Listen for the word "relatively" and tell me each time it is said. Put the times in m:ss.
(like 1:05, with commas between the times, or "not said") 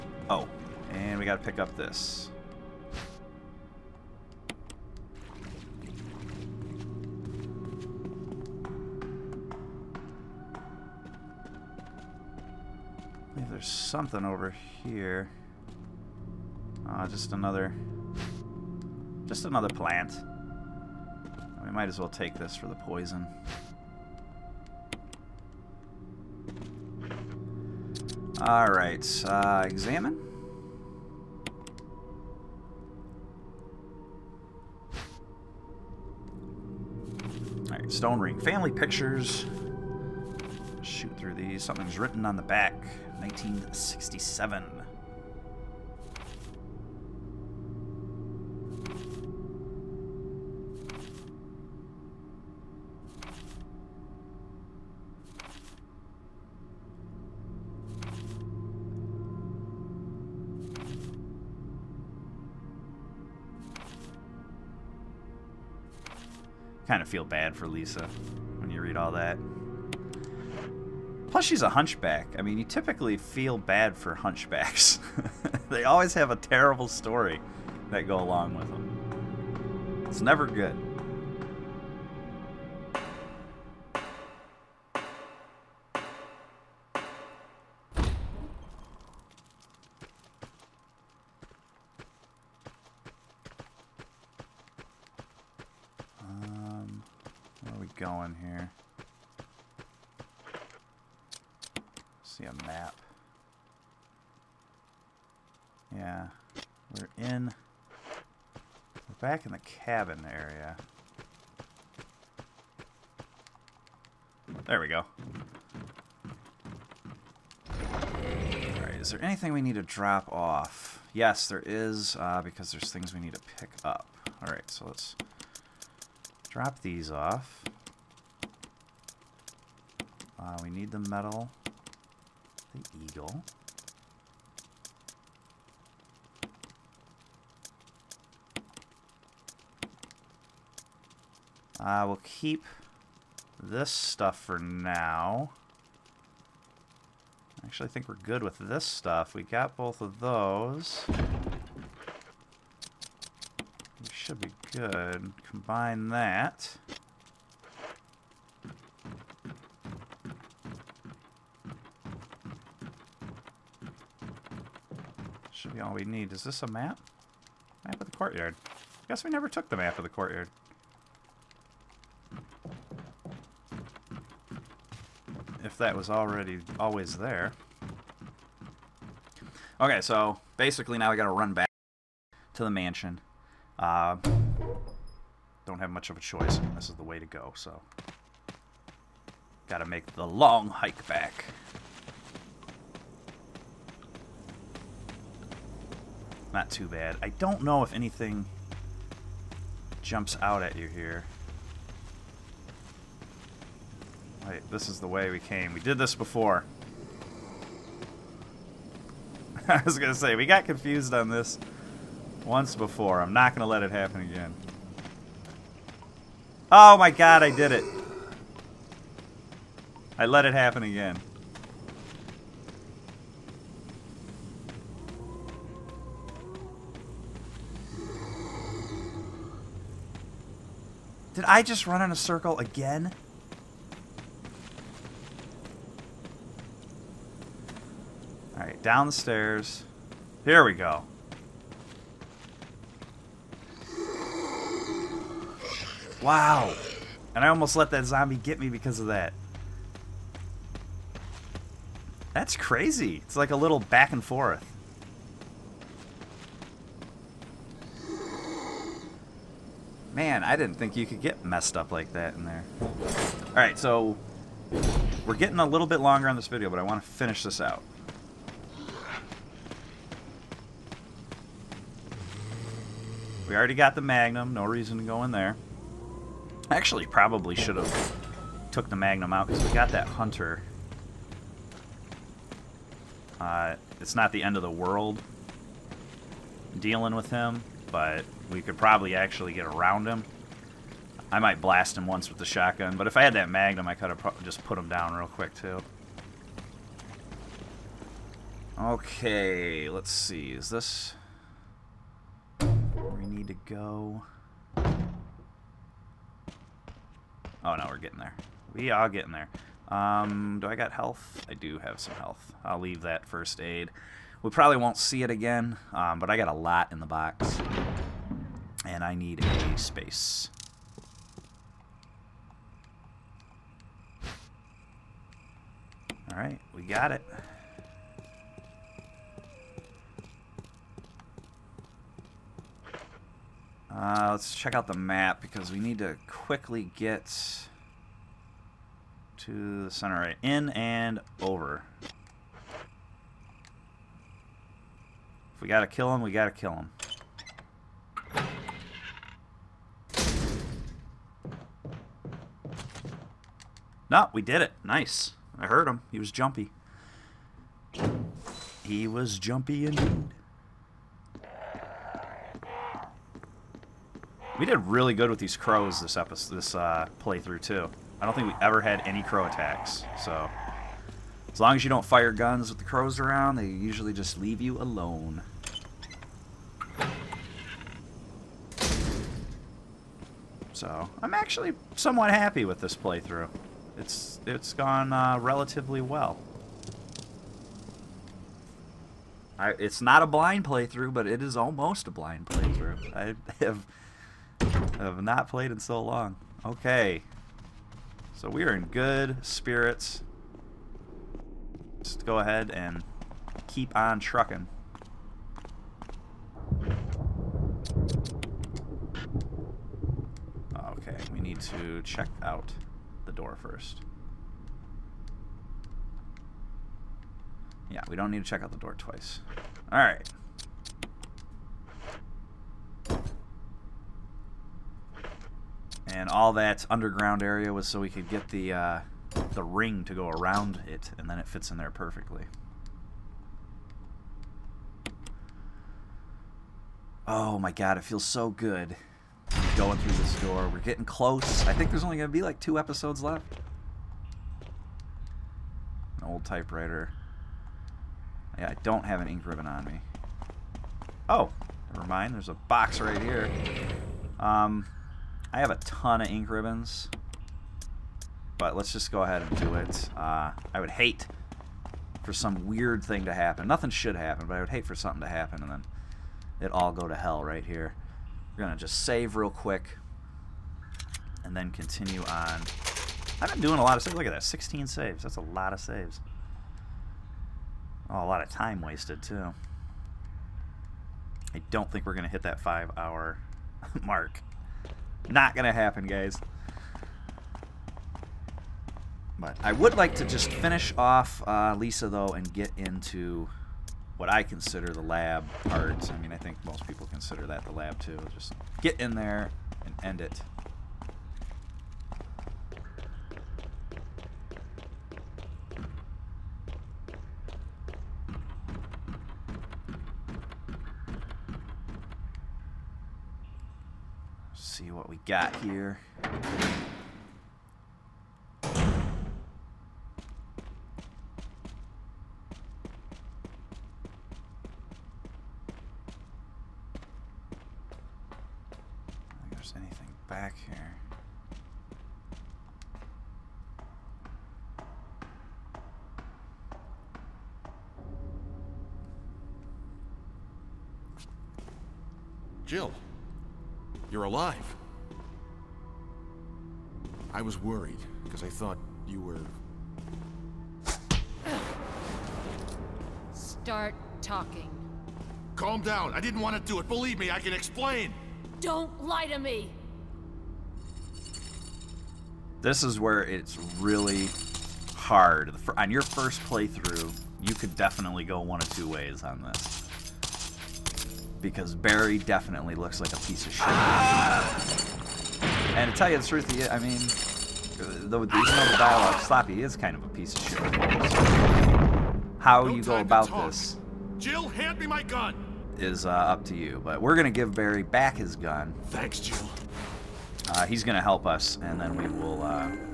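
6:25.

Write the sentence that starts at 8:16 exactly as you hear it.
I mean, I think most people consider that the lab, too.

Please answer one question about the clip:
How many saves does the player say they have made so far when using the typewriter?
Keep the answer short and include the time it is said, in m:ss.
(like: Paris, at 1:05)
16, at 7:54.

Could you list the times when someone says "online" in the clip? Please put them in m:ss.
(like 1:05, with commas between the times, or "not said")
not said.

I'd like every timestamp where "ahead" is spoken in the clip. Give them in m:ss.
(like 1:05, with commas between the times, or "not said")
6:42, 7:39.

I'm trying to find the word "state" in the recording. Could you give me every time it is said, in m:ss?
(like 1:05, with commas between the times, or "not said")
not said.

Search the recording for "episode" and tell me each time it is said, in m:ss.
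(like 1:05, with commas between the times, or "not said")
6:06, 7:22.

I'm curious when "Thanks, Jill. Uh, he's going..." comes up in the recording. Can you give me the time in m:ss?
9:48.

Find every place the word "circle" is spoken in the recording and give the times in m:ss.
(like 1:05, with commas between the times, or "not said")
3:52.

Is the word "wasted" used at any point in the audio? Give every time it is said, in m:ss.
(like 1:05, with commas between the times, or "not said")
7:58.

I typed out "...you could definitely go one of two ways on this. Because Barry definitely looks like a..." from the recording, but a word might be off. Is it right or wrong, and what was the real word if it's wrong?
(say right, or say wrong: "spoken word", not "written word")
right.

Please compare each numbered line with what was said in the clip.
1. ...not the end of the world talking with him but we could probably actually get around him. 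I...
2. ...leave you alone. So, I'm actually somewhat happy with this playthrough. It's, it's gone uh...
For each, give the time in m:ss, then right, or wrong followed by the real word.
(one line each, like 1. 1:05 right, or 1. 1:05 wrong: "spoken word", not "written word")
1. 4:44 wrong: "dealing", not "talking"
2. 6:14 right.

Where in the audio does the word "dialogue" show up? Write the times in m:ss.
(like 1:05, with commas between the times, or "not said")
9:38.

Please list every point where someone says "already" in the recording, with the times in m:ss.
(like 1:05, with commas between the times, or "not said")
2:56, 4:33.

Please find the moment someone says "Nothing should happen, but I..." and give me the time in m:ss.
7:43.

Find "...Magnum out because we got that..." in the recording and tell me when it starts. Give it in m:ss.
4:38.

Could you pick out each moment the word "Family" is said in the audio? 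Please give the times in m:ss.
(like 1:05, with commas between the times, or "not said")
0:38.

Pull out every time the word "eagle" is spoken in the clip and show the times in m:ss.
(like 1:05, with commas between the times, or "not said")
2:13.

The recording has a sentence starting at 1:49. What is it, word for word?
We're back in the cabin area.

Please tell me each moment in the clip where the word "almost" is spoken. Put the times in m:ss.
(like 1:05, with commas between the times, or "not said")
4:07, 6:31.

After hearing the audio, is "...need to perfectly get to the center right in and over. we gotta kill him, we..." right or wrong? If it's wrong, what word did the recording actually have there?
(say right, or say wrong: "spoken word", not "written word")
wrong: "quickly", not "perfectly".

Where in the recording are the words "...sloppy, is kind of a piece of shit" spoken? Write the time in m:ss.
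9:39.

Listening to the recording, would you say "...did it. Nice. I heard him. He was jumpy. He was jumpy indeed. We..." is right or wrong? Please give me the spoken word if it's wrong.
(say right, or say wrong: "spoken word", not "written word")
right.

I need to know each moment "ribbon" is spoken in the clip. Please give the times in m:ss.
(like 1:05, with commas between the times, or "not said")
7:29, 7:36.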